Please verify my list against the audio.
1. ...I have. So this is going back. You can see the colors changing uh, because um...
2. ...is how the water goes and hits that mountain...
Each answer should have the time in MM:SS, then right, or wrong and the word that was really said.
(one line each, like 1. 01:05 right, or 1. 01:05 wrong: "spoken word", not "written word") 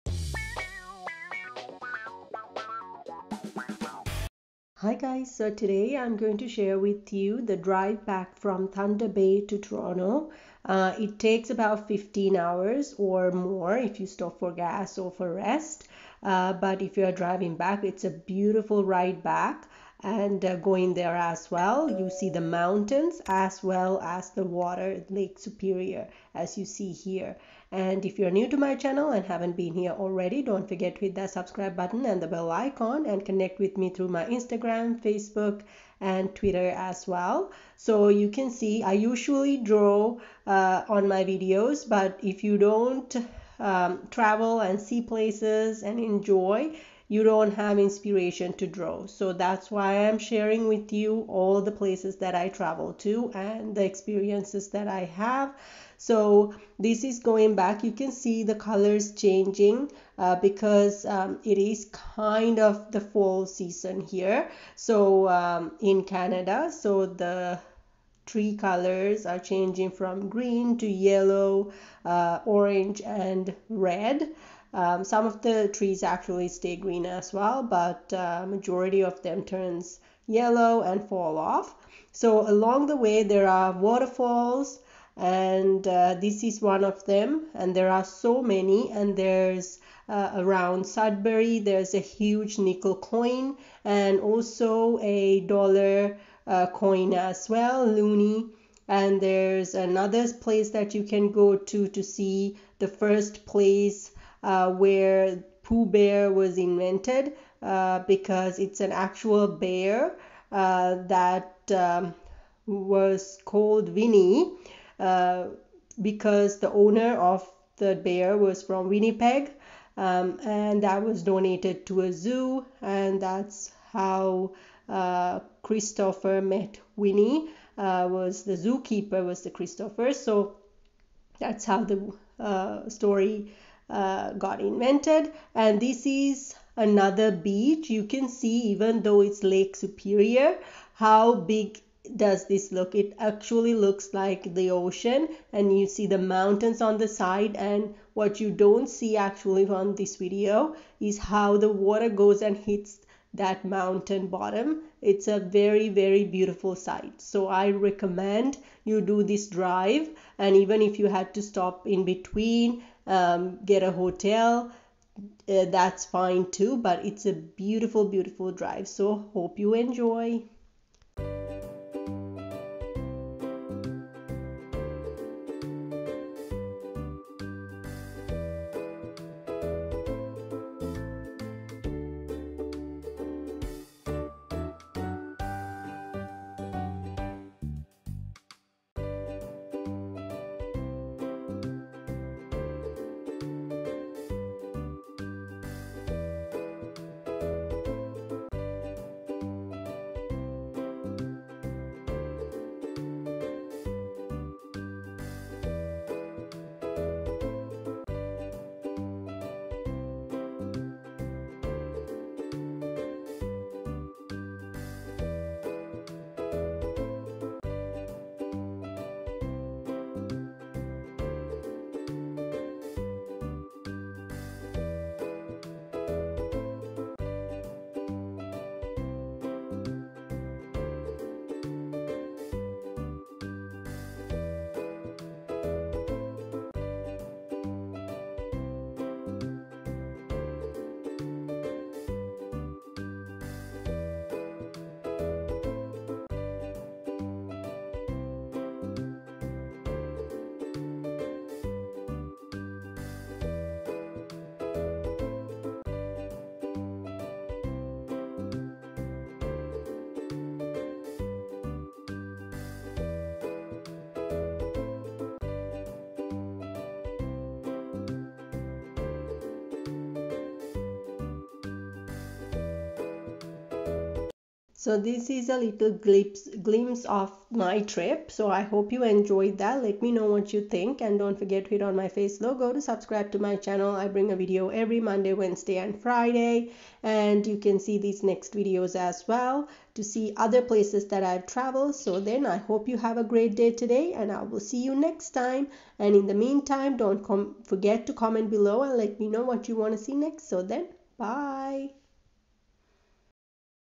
1. 00:54 right
2. 02:30 right.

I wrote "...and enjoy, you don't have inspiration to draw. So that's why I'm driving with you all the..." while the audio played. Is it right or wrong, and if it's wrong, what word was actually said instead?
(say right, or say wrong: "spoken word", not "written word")
wrong: "sharing", not "driving".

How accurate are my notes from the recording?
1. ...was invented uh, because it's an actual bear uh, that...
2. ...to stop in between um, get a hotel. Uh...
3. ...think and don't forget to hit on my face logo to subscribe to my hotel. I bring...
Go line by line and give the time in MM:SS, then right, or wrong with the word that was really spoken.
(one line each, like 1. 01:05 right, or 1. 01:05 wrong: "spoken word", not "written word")
1. 01:46 right
2. 02:41 right
3. 04:40 wrong: "channel", not "hotel".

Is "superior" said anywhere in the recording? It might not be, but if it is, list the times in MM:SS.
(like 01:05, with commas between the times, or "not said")
00:25, 02:19.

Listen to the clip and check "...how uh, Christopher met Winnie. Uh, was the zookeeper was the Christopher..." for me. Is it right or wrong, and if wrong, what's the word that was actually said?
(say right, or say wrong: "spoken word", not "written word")
right.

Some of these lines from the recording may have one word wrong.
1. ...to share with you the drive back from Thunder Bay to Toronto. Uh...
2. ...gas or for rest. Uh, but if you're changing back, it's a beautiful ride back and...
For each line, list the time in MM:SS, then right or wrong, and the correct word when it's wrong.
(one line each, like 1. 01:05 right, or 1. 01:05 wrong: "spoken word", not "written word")
1. 00:06 right
2. 00:14 wrong: "driving", not "changing".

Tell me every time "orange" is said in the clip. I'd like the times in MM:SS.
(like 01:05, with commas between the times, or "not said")
01:12.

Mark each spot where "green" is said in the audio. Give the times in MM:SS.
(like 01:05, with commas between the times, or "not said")
01:10, 01:16.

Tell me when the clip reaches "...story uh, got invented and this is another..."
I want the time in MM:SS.
02:12.